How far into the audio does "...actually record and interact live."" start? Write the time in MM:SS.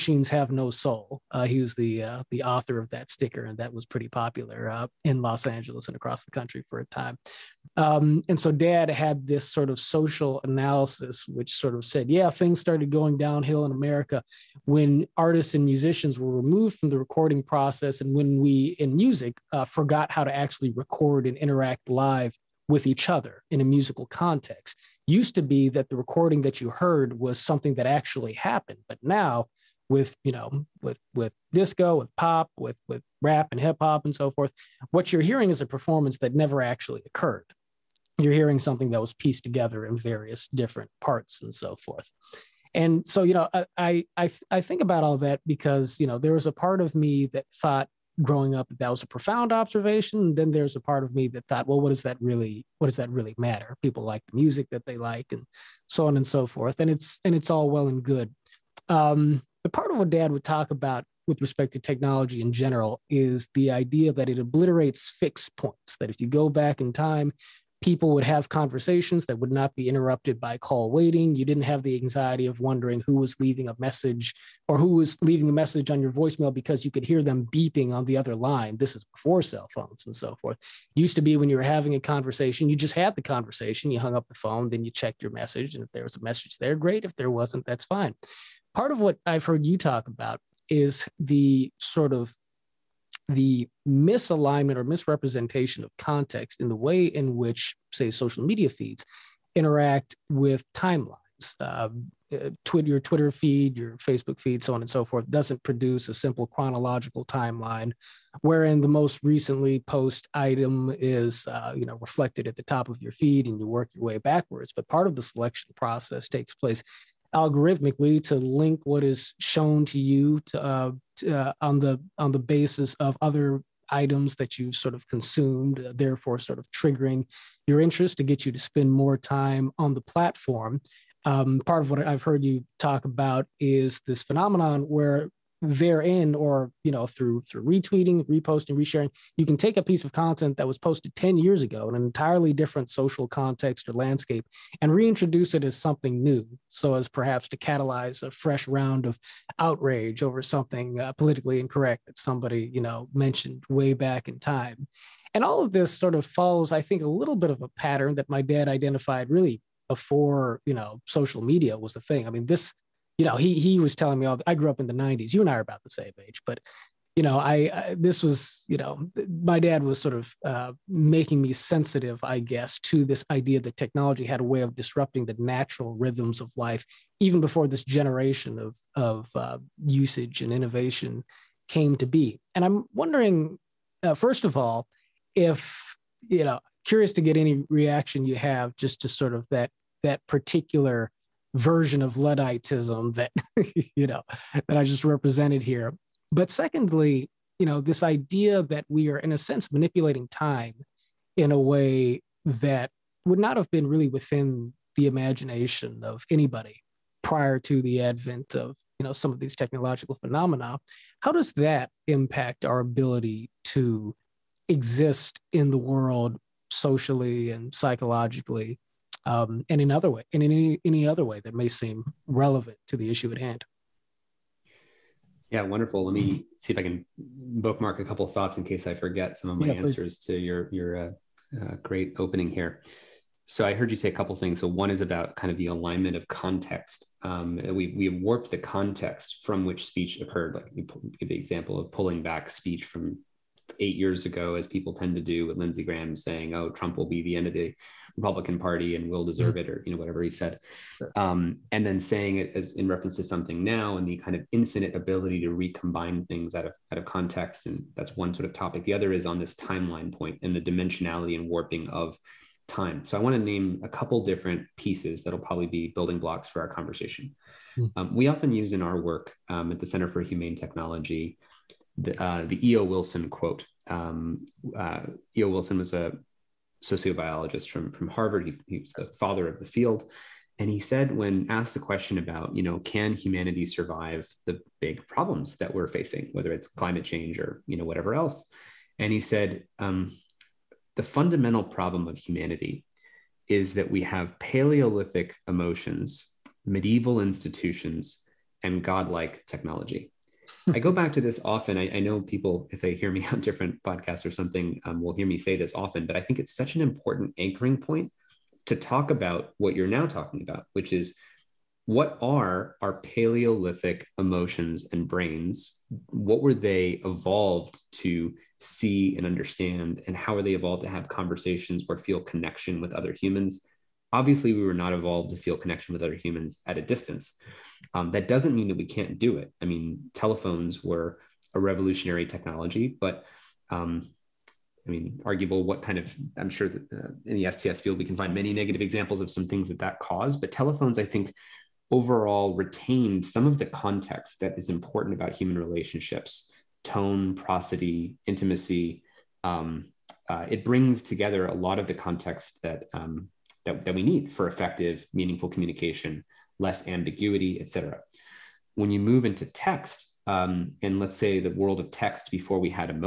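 00:20.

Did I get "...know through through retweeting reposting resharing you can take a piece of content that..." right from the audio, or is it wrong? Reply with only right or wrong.
right.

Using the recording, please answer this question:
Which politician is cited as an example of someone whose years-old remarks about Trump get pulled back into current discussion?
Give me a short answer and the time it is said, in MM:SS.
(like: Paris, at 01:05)
Lindsey Graham, at 04:05.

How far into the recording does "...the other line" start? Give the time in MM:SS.
01:18.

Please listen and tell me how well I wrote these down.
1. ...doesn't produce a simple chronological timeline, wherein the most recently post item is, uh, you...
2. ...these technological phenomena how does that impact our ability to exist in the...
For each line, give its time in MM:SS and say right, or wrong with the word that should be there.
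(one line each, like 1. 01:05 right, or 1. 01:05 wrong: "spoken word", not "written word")
1. 01:45 right
2. 03:29 right.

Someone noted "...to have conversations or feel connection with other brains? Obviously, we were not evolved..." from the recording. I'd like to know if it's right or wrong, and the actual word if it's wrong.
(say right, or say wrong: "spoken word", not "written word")
wrong: "humans", not "brains".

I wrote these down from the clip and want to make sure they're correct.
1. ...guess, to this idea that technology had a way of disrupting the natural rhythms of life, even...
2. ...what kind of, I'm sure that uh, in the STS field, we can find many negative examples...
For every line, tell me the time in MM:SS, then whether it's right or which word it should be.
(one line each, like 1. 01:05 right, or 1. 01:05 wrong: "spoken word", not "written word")
1. 02:52 right
2. 05:35 right.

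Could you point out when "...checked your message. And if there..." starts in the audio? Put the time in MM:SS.
01:24.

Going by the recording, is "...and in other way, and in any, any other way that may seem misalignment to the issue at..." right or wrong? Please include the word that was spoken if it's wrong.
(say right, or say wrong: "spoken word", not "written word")
wrong: "relevant", not "misalignment".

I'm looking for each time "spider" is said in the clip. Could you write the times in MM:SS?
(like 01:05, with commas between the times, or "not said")
not said.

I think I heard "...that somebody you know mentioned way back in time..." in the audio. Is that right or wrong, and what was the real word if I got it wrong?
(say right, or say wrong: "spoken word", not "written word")
right.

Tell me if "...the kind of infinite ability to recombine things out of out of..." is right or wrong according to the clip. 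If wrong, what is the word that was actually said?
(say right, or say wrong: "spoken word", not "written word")
right.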